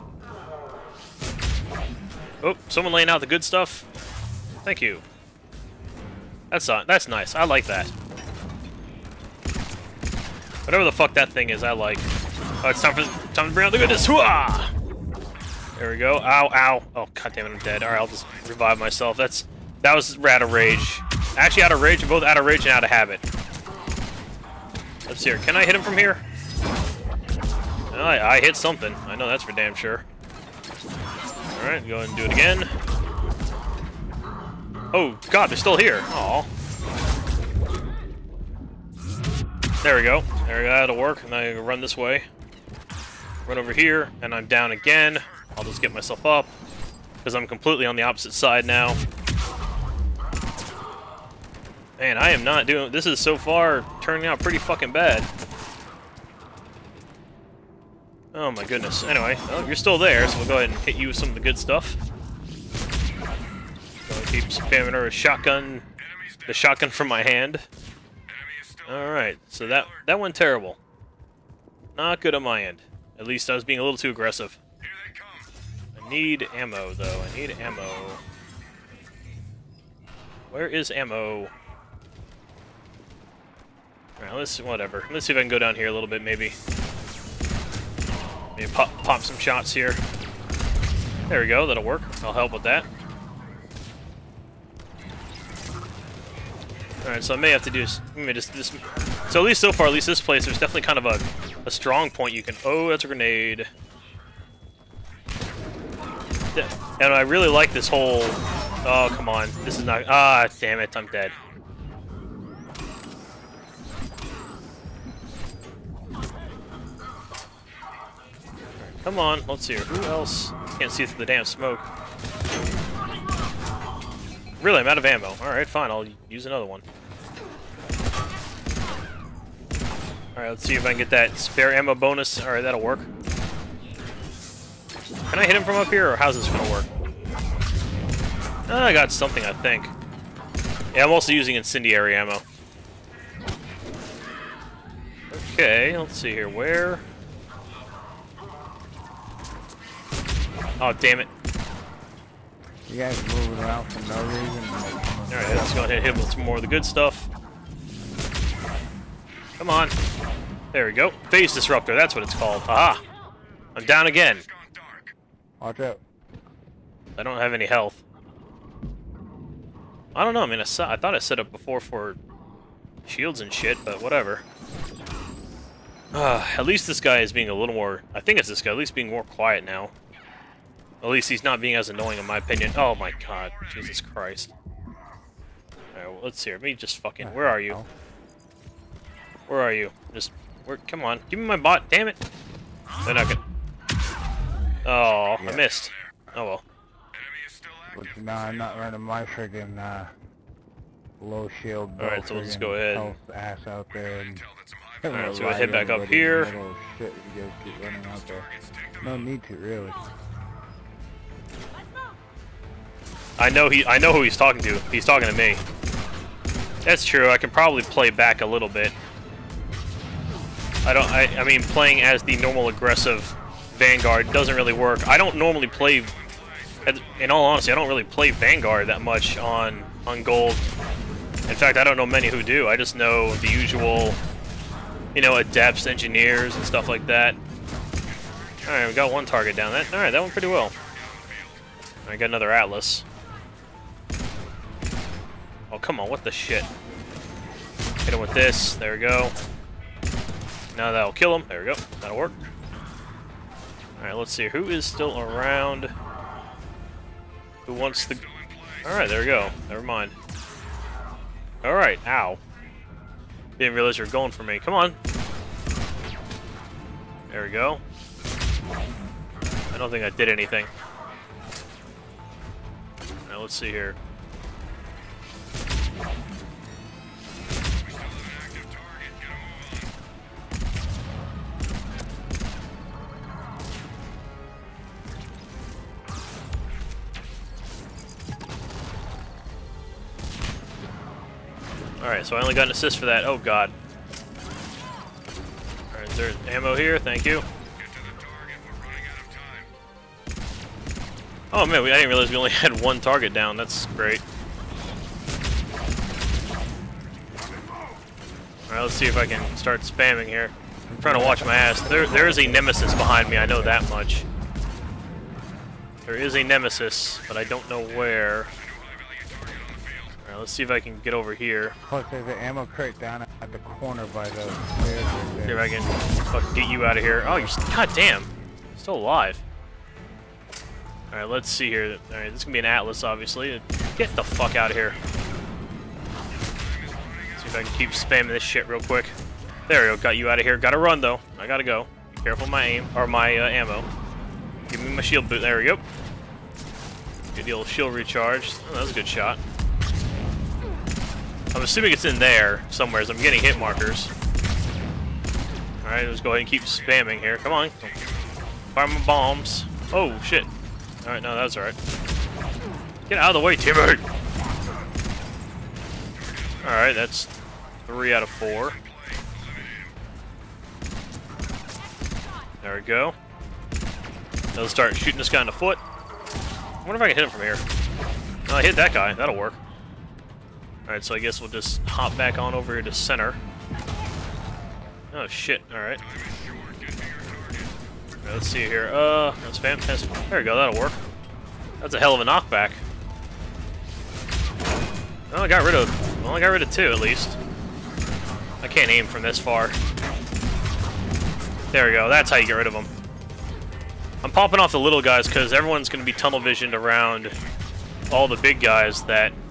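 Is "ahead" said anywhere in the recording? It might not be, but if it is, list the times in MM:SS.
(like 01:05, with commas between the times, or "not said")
00:31, 01:00, 02:35, 03:22, 05:56.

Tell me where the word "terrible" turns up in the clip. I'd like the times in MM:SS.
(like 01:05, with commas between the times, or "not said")
01:10.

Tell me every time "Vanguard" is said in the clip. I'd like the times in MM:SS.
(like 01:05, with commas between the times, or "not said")
03:43, 03:48.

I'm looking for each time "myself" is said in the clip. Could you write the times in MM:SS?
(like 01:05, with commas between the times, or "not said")
00:18, 00:45.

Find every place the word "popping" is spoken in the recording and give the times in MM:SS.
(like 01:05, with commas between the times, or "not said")
06:44.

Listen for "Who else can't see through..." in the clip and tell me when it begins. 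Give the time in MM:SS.
01:59.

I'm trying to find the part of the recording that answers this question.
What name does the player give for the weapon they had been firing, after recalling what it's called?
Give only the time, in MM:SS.
02:41.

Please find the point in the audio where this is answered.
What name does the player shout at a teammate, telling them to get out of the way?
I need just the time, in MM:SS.
06:03.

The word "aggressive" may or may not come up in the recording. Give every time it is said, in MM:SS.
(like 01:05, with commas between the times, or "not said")
01:14, 03:42.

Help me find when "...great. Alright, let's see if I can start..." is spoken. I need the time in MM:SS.
05:03.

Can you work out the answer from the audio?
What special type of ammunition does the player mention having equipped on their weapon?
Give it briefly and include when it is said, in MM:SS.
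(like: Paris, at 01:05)
Incendiary ammo, at 02:21.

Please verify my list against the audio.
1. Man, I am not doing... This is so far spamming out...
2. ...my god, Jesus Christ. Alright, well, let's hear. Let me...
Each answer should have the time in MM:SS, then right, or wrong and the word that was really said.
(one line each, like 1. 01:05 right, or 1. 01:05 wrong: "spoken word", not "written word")
1. 00:51 wrong: "turning", not "spamming"
2. 03:02 right.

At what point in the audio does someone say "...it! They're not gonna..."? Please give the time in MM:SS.
03:12.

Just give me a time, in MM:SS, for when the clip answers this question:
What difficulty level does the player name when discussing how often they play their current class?
03:50.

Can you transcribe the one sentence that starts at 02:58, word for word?
I think it's this guy, at least being more quiet now.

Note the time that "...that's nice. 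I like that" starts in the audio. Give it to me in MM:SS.
00:06.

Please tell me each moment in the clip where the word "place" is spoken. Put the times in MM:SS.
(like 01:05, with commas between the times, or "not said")
01:40.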